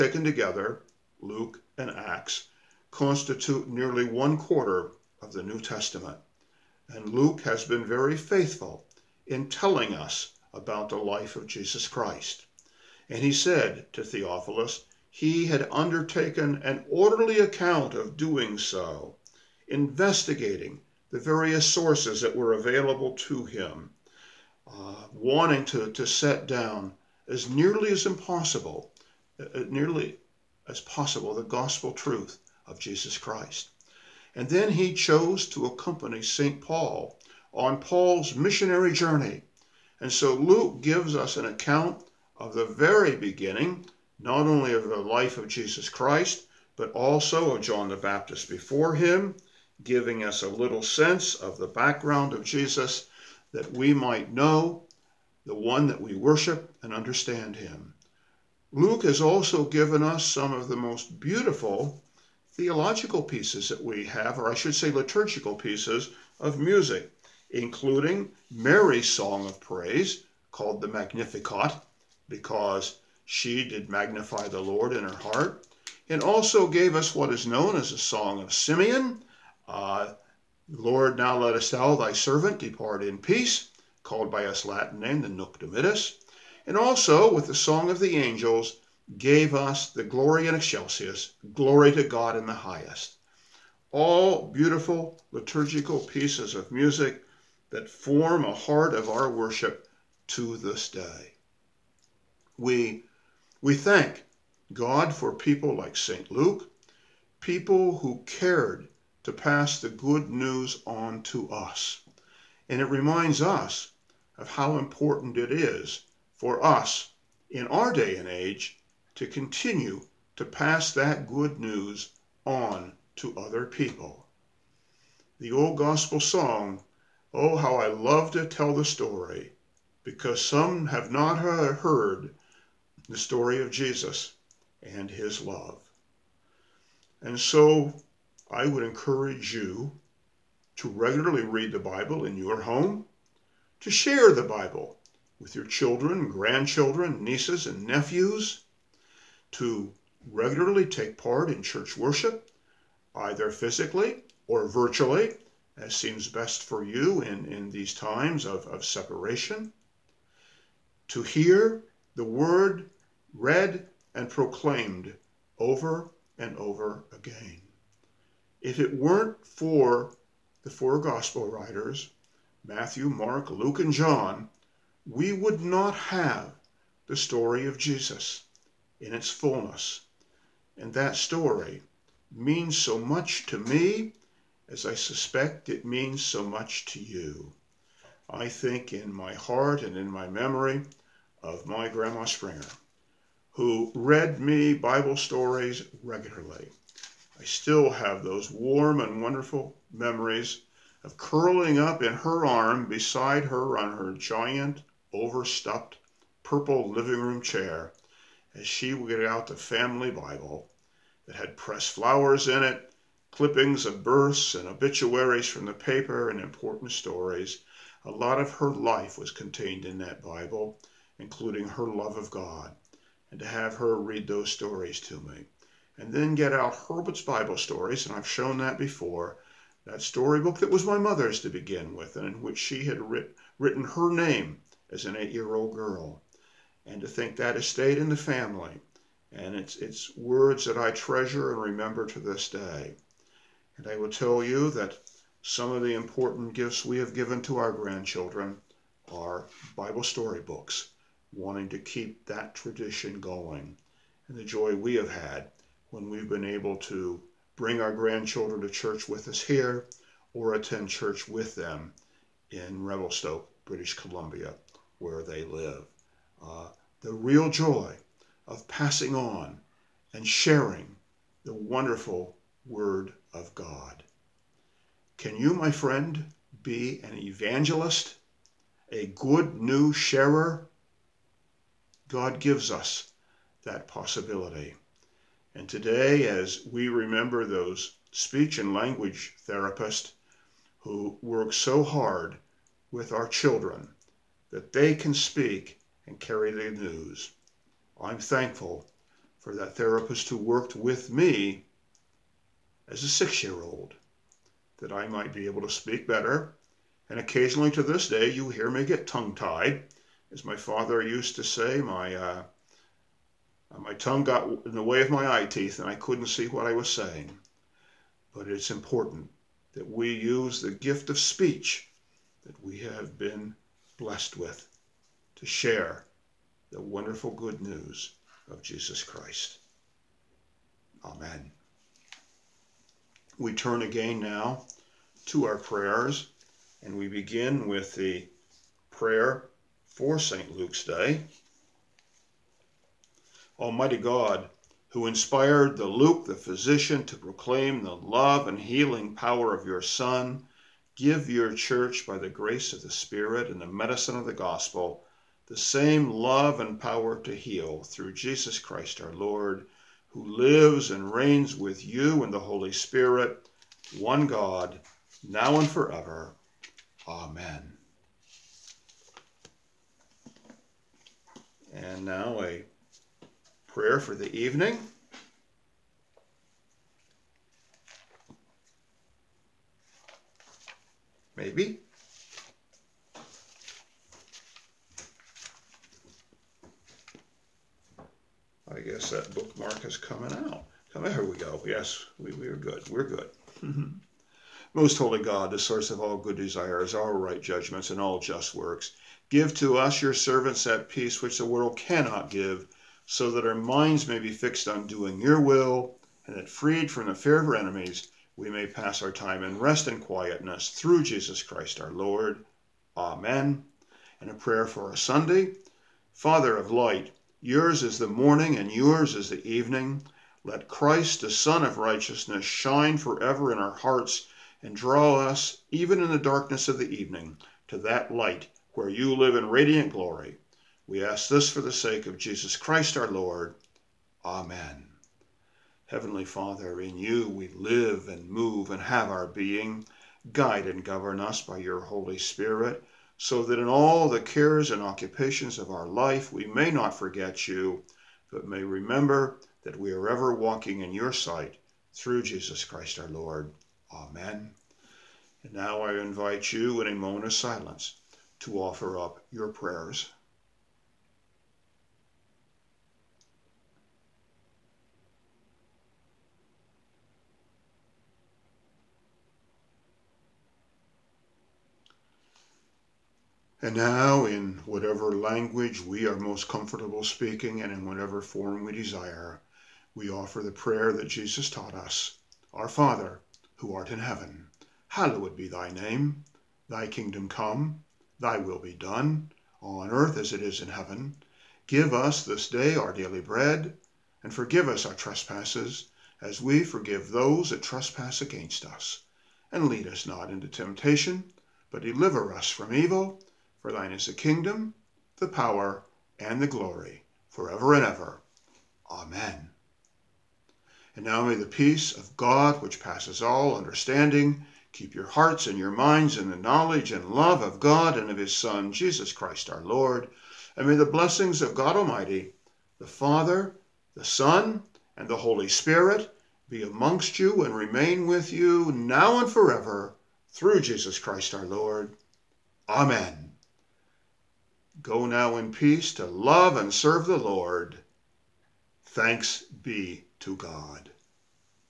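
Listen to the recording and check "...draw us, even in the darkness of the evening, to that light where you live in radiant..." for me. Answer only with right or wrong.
right.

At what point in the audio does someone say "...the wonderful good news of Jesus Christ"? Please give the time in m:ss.
5:26.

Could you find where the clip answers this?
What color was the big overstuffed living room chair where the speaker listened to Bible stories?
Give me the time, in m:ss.
3:26.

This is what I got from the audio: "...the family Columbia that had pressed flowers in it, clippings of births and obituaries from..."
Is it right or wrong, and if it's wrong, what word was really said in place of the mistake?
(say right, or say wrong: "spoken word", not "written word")
wrong: "Bible", not "Columbia".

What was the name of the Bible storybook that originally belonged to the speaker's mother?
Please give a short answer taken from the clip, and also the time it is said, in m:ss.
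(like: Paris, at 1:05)
Herbert's Bible Stories, at 3:46.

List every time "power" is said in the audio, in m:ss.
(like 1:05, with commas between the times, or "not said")
5:49, 5:56, 8:25.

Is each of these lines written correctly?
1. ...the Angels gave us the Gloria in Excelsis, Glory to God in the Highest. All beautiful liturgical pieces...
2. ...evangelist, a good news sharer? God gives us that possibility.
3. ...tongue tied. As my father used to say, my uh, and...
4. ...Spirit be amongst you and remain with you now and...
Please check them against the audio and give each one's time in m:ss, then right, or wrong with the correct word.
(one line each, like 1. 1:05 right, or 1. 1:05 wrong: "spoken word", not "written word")
1. 1:27 right
2. 4:37 right
3. 5:09 right
4. 8:45 right.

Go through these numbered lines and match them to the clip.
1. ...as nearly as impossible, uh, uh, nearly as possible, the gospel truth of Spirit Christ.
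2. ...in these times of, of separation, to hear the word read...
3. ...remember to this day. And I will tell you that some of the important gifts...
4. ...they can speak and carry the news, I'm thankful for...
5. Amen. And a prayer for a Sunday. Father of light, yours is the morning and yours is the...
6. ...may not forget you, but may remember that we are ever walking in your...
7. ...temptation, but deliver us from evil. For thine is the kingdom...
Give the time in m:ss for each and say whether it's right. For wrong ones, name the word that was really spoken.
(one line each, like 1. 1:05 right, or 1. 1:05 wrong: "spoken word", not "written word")
1. 0:27 wrong: "Jesus", not "Spirit"
2. 2:37 right
3. 4:01 right
4. 4:54 right
5. 6:52 right
6. 7:26 right
7. 8:20 right.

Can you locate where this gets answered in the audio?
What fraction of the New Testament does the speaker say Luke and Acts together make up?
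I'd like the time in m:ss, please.
0:03.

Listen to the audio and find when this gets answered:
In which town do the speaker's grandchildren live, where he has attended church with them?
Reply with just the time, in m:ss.
4:22.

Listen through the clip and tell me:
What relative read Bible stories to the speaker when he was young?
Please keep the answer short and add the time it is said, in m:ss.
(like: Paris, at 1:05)
Grandma Springer, at 3:11.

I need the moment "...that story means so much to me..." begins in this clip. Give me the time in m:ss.
3:00.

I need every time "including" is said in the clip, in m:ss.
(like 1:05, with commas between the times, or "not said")
1:07, 3:41.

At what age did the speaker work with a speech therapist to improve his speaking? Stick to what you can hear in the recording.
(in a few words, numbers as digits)
6.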